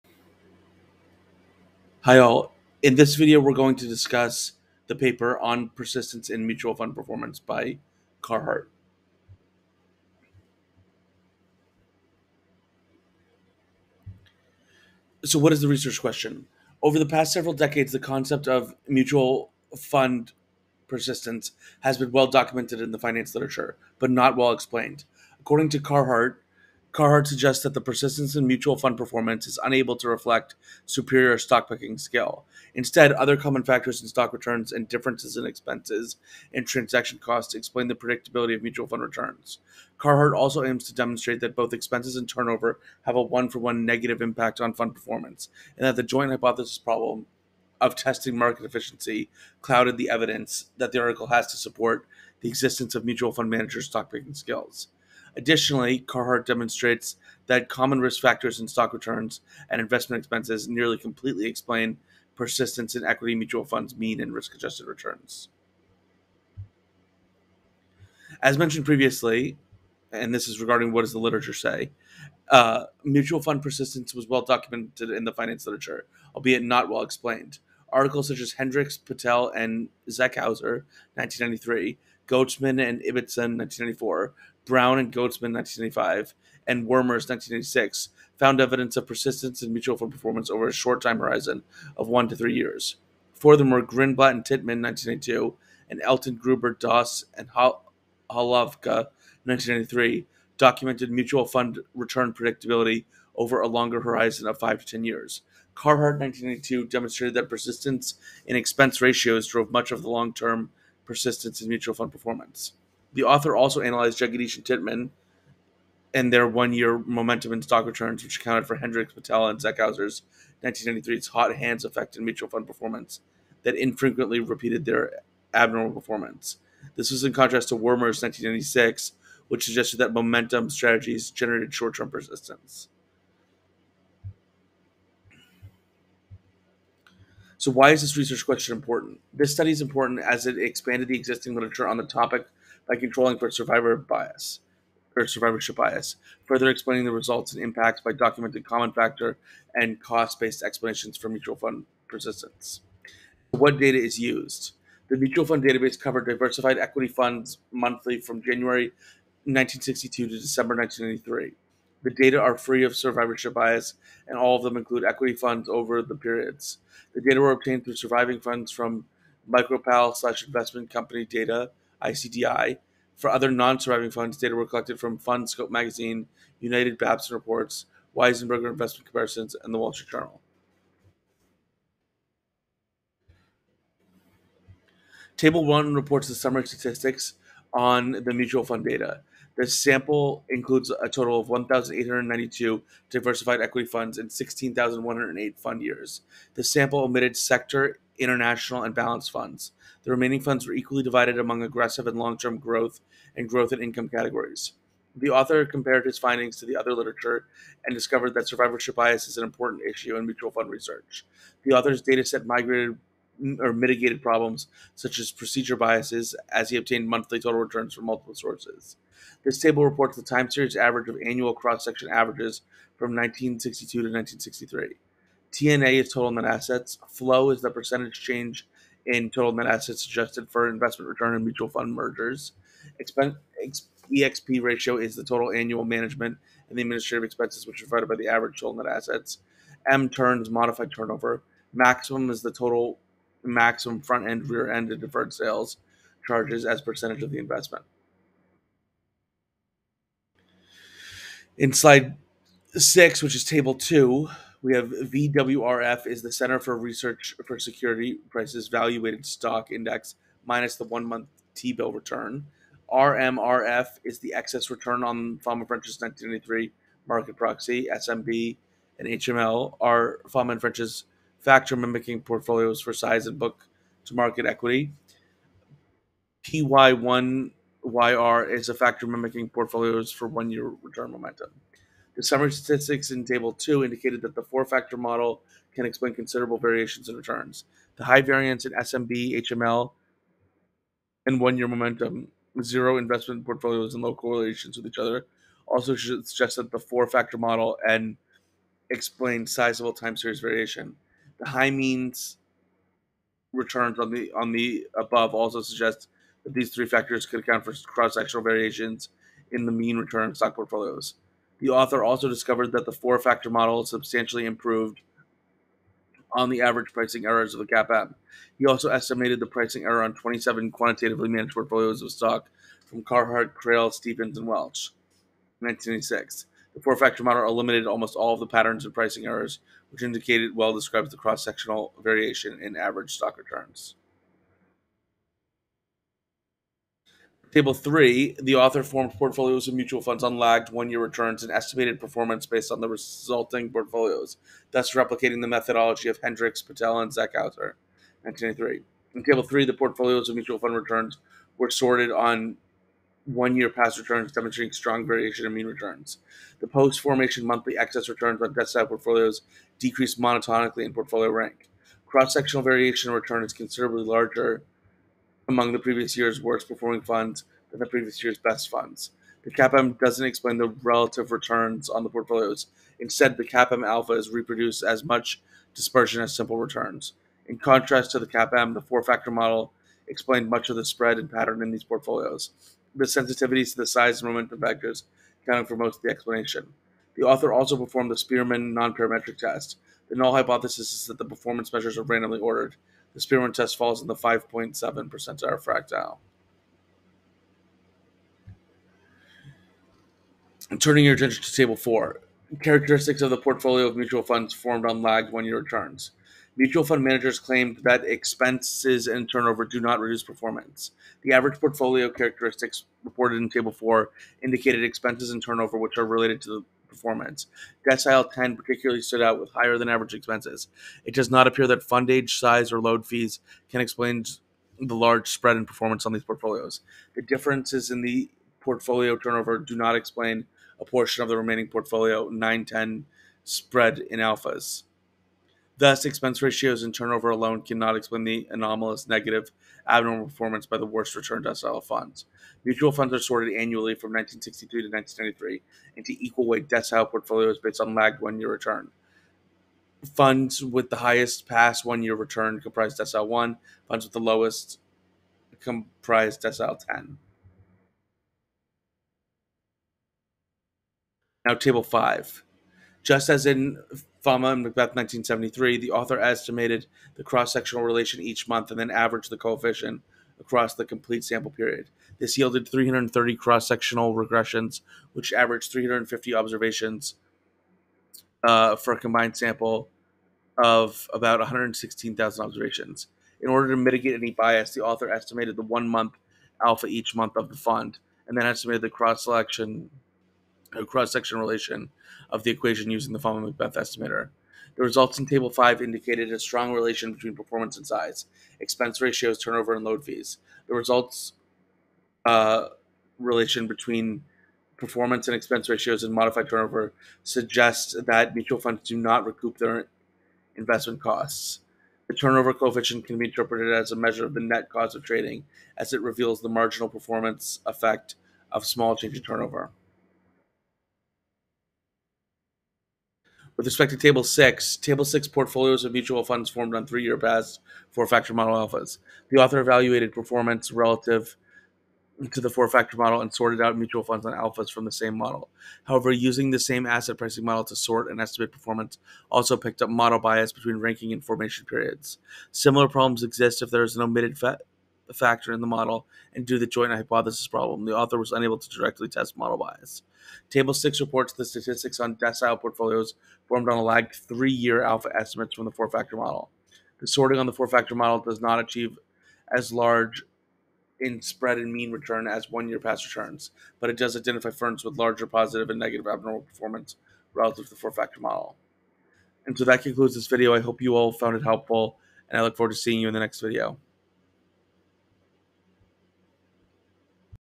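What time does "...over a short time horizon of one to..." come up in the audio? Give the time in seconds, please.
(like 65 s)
90 s.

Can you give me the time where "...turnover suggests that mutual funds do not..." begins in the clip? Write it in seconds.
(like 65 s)
506 s.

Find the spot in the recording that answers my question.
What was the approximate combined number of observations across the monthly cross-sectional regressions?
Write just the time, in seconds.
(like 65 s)
481 s.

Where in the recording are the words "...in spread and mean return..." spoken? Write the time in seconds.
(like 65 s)
560 s.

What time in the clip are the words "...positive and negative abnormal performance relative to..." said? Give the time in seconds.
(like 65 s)
565 s.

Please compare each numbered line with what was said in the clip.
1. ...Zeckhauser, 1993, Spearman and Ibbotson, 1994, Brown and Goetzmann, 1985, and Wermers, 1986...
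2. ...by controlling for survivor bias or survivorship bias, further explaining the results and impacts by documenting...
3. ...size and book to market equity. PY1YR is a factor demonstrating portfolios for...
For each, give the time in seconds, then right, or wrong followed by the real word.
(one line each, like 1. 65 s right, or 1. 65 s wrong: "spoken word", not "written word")
1. 80 s wrong: "Goetzmann", not "Spearman"
2. 142 s right
3. 272 s wrong: "mimicking", not "demonstrating".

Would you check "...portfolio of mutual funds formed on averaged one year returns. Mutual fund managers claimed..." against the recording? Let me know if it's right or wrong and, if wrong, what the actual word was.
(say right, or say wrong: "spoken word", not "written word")
wrong: "lagged", not "averaged".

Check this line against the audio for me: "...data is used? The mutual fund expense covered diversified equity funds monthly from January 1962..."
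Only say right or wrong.
wrong.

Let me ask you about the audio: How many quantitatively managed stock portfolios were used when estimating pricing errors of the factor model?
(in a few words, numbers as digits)
27.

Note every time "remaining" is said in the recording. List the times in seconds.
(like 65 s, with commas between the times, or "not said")
200 s, 431 s.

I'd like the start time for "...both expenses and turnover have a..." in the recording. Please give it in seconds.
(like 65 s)
41 s.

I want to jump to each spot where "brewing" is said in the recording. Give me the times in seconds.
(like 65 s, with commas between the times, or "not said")
not said.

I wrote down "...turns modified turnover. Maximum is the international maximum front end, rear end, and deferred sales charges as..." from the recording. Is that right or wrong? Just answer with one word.
wrong.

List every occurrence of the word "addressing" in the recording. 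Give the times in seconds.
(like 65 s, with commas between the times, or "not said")
not said.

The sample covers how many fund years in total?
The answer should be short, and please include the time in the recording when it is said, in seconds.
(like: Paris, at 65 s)
16,108, at 194 s.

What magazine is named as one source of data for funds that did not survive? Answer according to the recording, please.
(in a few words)
FundScope Magazine.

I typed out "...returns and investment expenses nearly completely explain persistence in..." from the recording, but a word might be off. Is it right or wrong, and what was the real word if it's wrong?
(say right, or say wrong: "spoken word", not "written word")
right.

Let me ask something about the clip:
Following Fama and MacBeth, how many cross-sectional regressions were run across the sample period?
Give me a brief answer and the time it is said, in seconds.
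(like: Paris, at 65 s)
330, at 472 s.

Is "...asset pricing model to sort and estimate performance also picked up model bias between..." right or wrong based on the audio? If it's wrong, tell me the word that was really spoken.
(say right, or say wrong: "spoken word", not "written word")
right.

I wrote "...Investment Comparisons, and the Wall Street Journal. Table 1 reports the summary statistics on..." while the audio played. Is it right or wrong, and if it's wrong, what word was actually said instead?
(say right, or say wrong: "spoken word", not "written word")
right.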